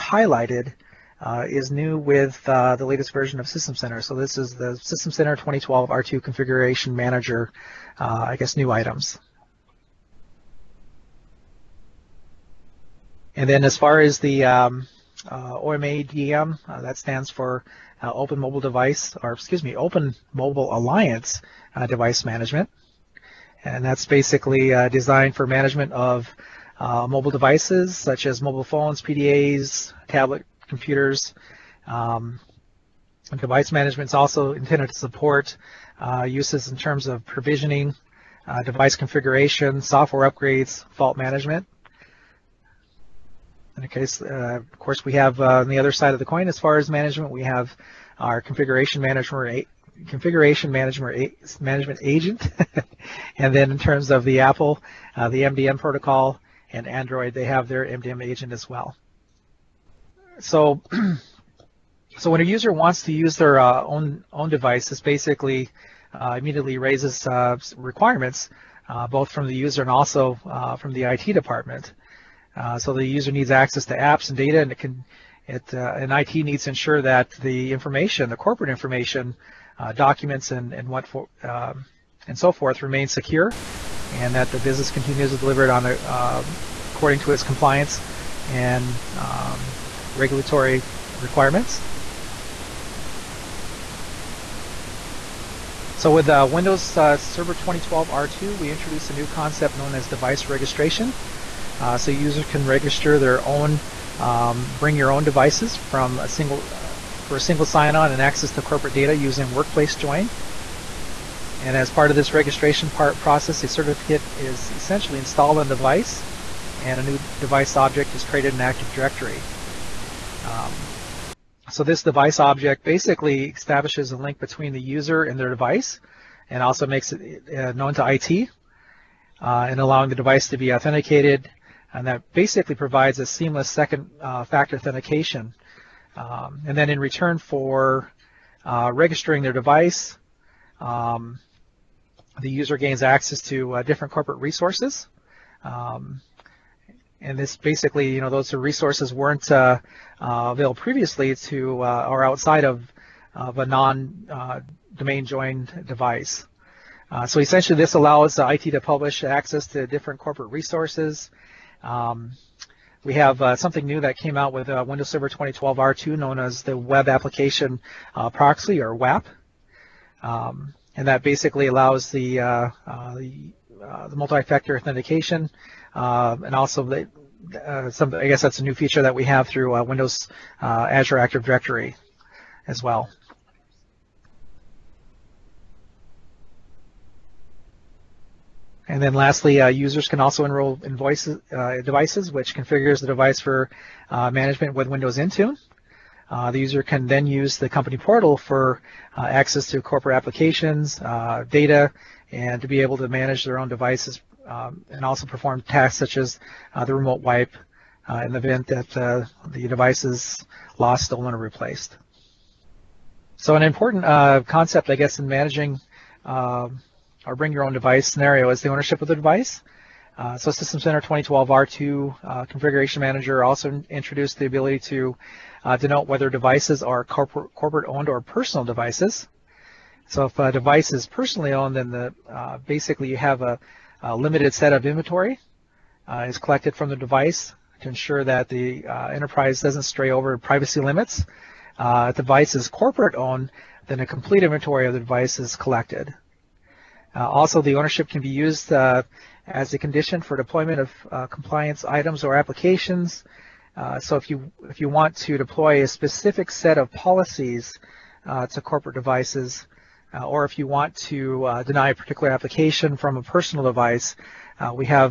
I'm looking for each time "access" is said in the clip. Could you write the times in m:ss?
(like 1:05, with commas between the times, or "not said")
1:13, 1:48, 2:23, 2:39, 3:19.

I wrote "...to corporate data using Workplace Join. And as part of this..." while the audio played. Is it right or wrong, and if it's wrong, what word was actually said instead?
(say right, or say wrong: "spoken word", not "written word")
right.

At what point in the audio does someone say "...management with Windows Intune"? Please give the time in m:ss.
3:14.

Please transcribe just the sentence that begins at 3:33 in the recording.
So an important uh, concept, I guess, in managing um, or bring your own device scenario is the ownership of the device.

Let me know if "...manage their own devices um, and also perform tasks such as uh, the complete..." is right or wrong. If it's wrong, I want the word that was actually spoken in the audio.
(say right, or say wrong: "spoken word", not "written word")
wrong: "remote", not "complete".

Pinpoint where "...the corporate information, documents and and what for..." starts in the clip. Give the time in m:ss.
1:18.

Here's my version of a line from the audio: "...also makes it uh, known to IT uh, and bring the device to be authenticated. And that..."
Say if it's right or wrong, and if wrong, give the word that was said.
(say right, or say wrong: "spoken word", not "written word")
wrong: "allowing", not "bring".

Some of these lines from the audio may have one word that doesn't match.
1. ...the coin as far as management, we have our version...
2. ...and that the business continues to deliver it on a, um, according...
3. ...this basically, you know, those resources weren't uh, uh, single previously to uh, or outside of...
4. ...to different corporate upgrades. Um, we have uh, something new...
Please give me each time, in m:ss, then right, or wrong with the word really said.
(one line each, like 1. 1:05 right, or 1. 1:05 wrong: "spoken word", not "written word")
1. 0:46 wrong: "configuration", not "version"
2. 1:24 right
3. 2:27 wrong: "available", not "single"
4. 2:39 wrong: "resources", not "upgrades".